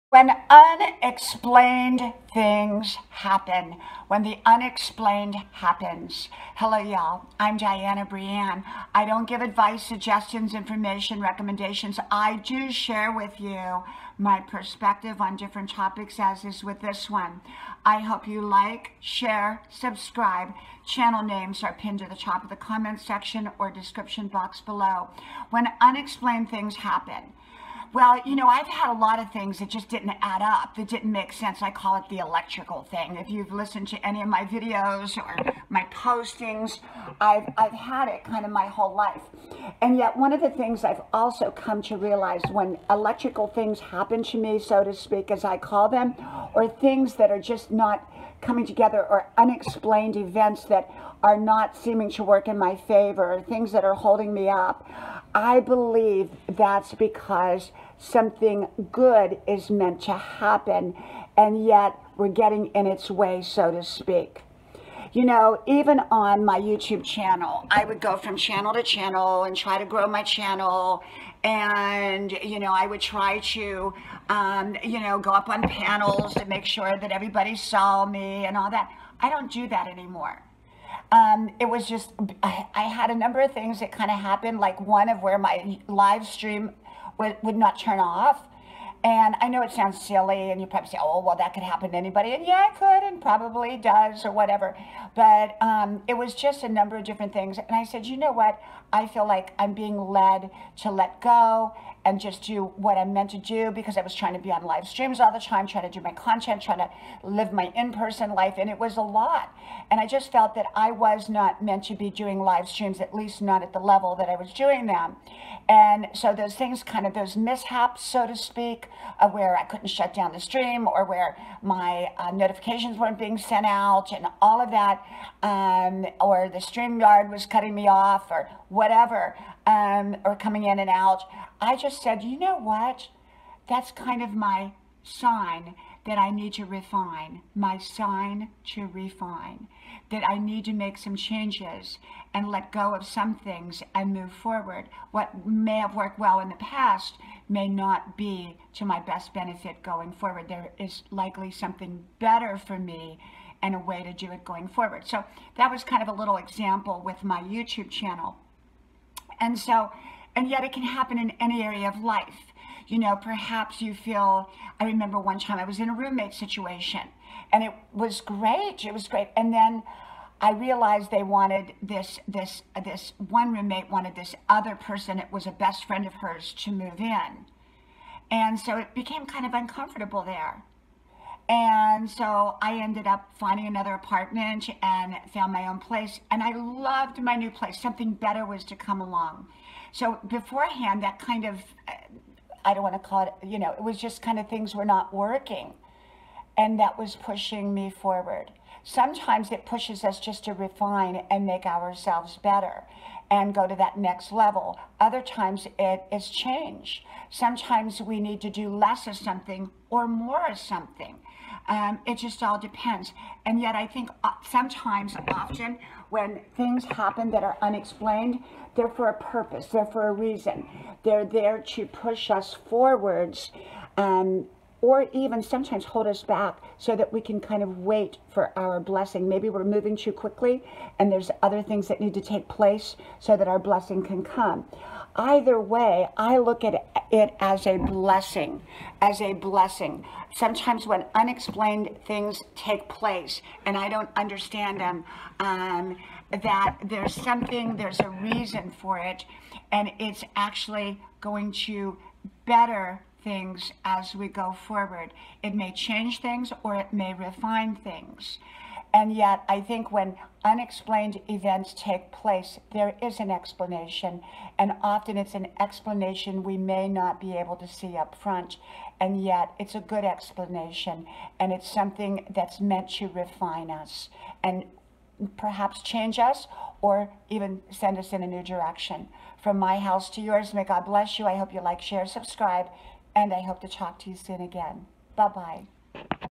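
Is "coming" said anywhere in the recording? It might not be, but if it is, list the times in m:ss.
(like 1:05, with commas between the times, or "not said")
0:48, 2:10.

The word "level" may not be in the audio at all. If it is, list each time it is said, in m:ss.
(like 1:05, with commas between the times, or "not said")
1:53, 3:24.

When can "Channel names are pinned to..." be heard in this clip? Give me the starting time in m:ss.
0:20.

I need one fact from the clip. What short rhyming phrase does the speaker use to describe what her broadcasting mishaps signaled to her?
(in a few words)
my sign to refine.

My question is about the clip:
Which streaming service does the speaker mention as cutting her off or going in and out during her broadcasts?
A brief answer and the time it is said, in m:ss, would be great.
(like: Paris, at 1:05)
StreamYard, at 2:06.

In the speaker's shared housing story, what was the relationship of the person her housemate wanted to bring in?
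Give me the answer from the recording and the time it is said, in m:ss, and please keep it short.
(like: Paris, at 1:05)
best friend, at 2:55.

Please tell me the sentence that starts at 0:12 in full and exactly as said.
I do share with you my perspective on different topics, as is with this one.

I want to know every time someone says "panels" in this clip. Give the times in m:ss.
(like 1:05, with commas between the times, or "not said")
1:15.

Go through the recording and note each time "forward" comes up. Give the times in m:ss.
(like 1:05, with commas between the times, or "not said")
2:24, 2:30, 2:34, 3:17, 3:42, 4:14.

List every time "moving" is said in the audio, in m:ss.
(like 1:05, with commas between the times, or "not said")
3:49.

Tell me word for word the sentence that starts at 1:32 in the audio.
And yeah, it could, and probably does, or whatever.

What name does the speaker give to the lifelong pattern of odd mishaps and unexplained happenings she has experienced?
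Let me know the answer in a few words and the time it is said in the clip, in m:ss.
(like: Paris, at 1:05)
the electrical thing, at 0:32.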